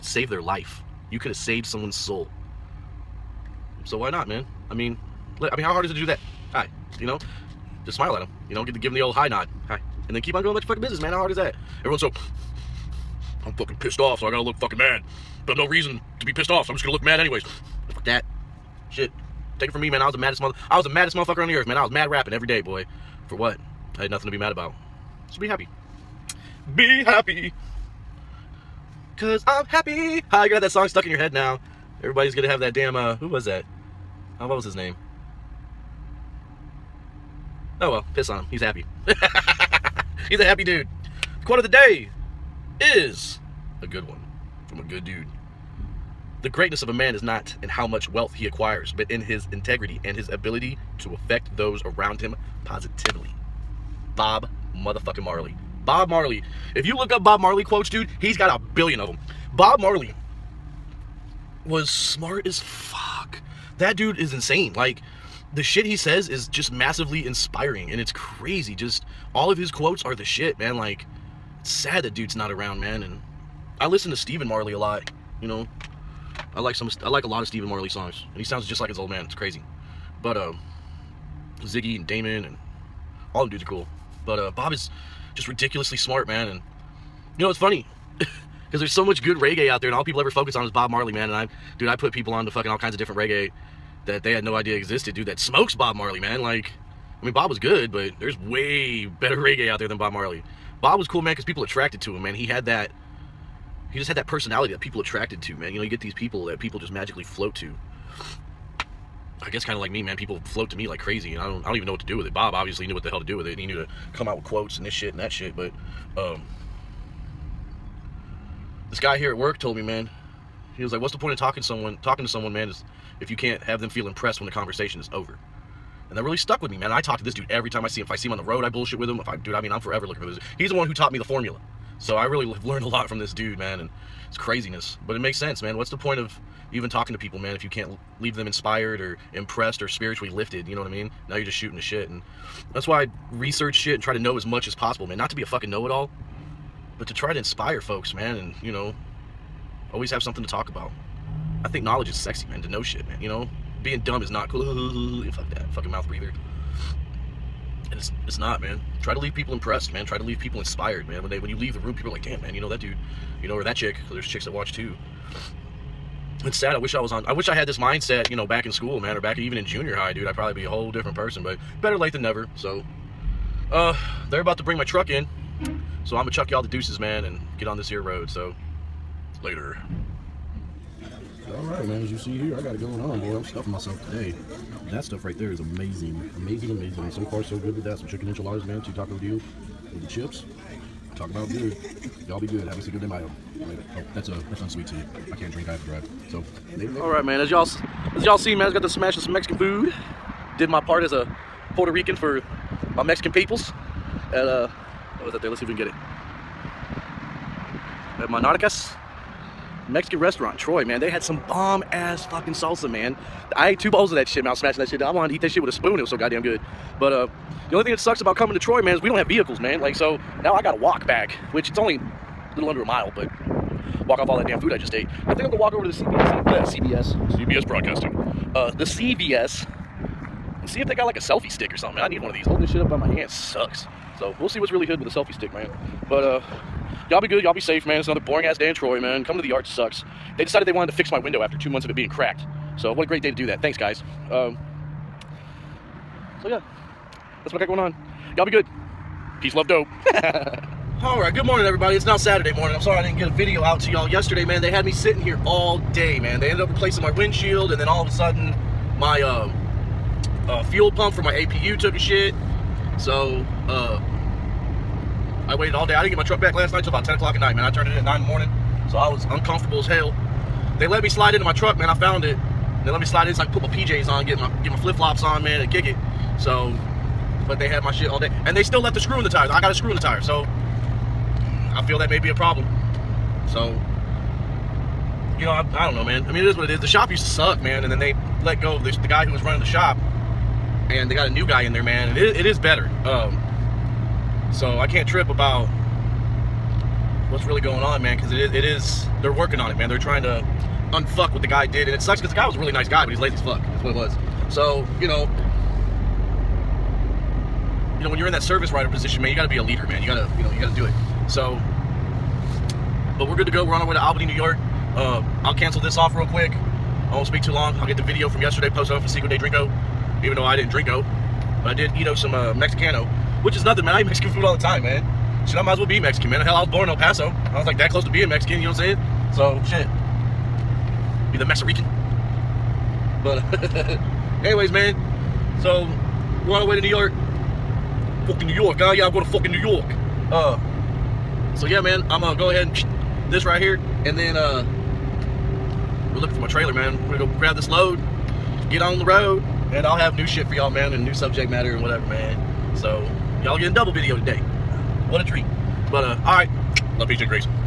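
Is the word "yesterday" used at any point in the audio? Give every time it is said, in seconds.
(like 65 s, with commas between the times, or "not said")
254 s, 318 s.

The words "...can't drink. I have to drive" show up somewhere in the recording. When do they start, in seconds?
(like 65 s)
195 s.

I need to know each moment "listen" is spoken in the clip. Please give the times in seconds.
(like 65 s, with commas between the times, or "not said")
73 s.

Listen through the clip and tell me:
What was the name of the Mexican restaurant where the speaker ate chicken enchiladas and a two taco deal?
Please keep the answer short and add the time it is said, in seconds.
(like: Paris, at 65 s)
Monarcas, at 208 s.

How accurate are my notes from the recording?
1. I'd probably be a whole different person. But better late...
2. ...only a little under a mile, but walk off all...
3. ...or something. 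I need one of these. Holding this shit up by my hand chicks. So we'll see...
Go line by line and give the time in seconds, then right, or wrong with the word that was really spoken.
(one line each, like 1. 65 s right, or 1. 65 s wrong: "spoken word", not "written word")
1. 170 s right
2. 221 s right
3. 231 s wrong: "sucks", not "chicks".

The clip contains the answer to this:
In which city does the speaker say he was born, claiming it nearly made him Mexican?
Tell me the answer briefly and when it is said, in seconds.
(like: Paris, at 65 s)
El Paso, at 326 s.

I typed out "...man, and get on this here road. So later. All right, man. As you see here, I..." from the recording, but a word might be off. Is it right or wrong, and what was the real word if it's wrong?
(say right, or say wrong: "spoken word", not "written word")
right.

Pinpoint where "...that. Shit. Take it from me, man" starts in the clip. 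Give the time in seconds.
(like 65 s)
18 s.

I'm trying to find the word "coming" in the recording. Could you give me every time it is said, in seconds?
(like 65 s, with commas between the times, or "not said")
218 s, 239 s.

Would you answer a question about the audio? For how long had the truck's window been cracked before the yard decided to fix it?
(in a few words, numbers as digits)
2 months.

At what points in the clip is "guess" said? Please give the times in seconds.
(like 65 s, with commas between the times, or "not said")
109 s.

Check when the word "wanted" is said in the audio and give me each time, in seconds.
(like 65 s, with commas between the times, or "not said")
215 s, 240 s.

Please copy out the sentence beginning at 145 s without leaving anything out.
Not to be a fucking know it all, but to try to inspire folks, man.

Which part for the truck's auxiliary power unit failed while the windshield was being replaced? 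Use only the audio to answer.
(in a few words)
fuel pump.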